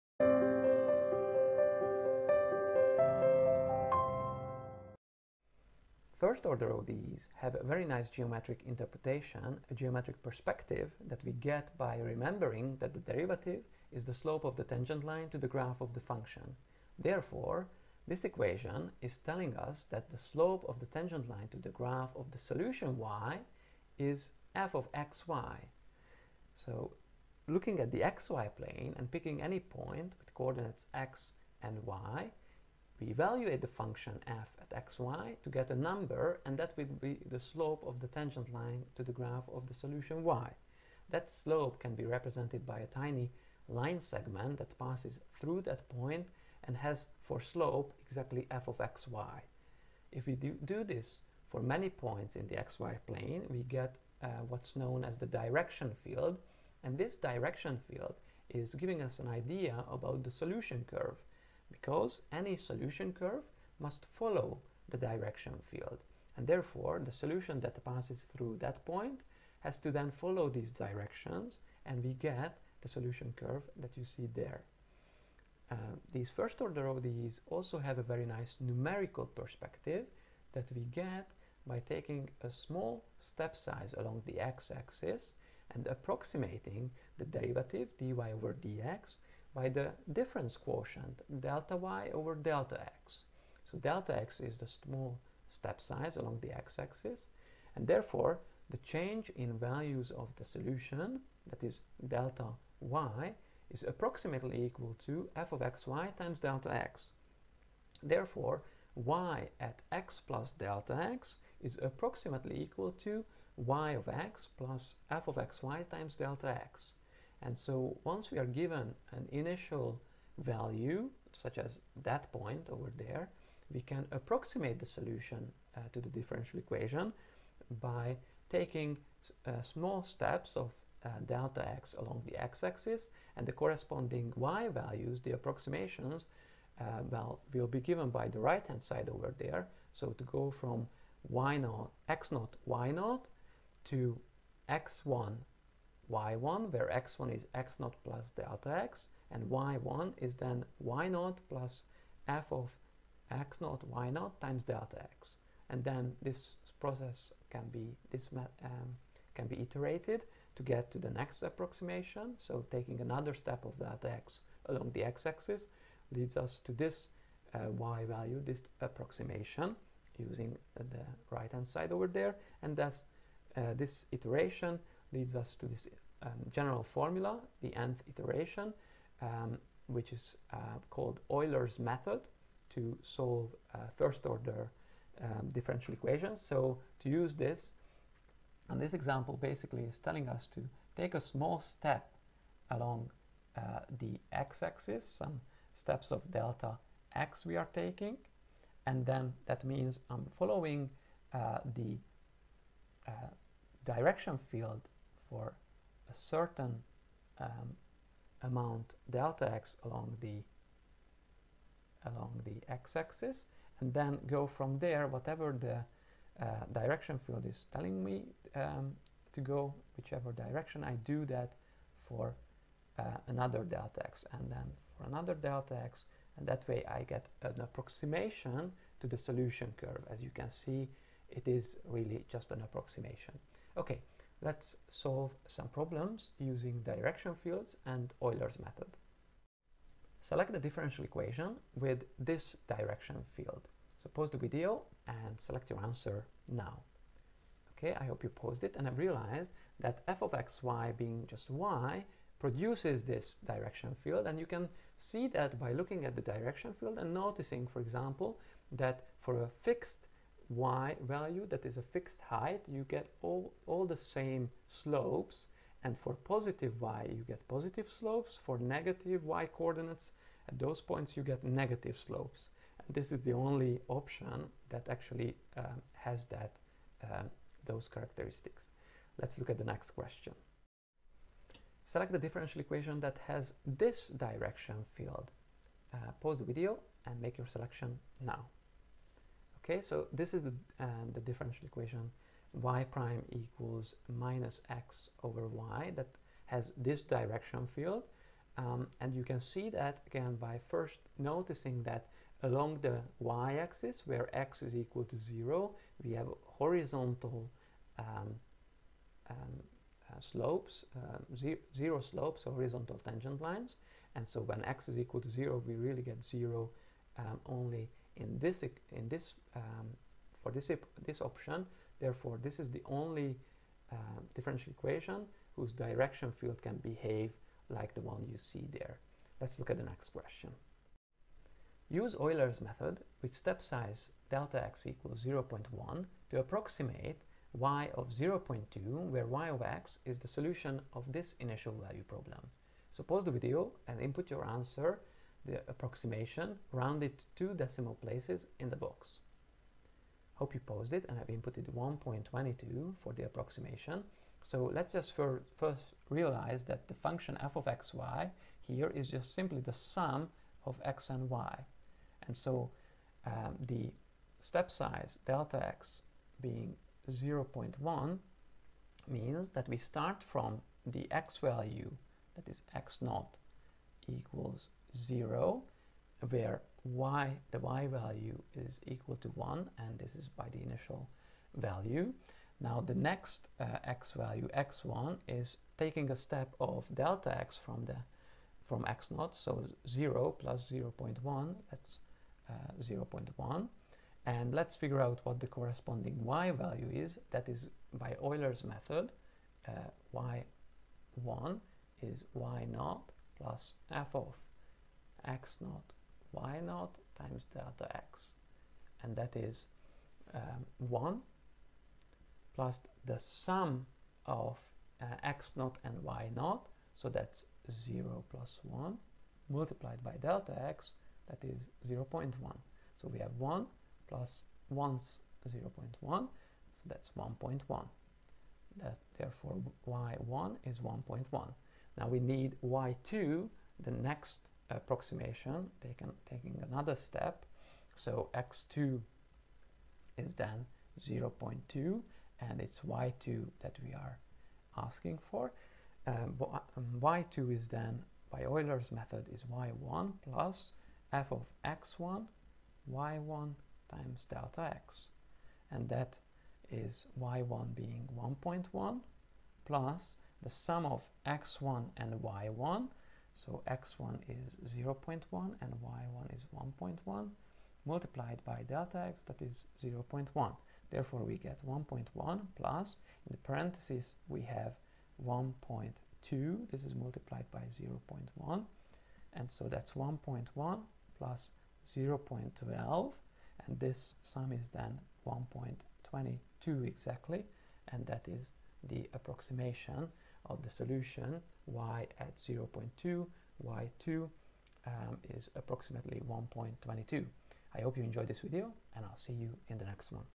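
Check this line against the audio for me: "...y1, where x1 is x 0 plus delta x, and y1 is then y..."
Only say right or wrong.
right.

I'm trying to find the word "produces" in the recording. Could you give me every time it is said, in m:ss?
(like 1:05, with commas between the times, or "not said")
4:12.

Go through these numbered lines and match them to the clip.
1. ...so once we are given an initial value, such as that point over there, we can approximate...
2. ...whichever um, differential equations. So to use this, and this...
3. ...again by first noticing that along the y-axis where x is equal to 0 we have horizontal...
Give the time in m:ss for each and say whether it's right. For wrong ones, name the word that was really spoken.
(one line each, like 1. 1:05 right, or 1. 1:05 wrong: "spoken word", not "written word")
1. 1:57 right
2. 3:04 wrong: "order", not "whichever"
3. 5:00 right.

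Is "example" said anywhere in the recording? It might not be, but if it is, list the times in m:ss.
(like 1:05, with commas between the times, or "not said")
3:08, 4:17.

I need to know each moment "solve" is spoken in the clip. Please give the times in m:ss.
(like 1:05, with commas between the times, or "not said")
3:03, 3:54.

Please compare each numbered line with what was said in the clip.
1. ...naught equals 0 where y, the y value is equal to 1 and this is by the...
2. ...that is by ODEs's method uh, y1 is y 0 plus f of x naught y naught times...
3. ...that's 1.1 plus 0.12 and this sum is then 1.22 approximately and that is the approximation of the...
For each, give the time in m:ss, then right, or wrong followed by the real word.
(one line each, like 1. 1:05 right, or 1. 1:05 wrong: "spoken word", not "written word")
1. 6:13 right
2. 6:37 wrong: "Euler", not "ODEs"
3. 7:59 wrong: "exactly", not "approximately".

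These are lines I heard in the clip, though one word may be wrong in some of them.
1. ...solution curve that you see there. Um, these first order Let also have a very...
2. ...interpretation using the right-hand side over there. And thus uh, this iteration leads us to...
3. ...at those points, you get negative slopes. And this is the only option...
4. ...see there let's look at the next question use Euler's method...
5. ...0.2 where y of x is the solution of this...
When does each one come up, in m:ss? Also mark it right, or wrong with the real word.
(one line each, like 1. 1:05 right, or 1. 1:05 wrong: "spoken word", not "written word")
1. 1:12 wrong: "ODEs", not "Let"
2. 2:48 wrong: "approximation", not "interpretation"
3. 4:30 right
4. 5:28 right
5. 5:38 right.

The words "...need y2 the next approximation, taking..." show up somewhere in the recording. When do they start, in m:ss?
7:12.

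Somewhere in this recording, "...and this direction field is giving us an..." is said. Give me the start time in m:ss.
0:56.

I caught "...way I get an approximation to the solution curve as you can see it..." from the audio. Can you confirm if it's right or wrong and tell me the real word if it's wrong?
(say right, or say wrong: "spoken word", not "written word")
right.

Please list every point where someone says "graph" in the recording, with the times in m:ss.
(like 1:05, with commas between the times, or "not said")
0:15, 0:21, 0:39.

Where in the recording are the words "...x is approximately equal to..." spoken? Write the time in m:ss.
1:51.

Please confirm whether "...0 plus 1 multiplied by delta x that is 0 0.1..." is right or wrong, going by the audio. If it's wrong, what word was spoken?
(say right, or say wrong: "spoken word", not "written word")
right.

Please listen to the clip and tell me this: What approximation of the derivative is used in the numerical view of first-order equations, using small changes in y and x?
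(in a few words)
difference quotient.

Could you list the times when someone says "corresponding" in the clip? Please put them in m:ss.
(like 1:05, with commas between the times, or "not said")
2:13, 6:35.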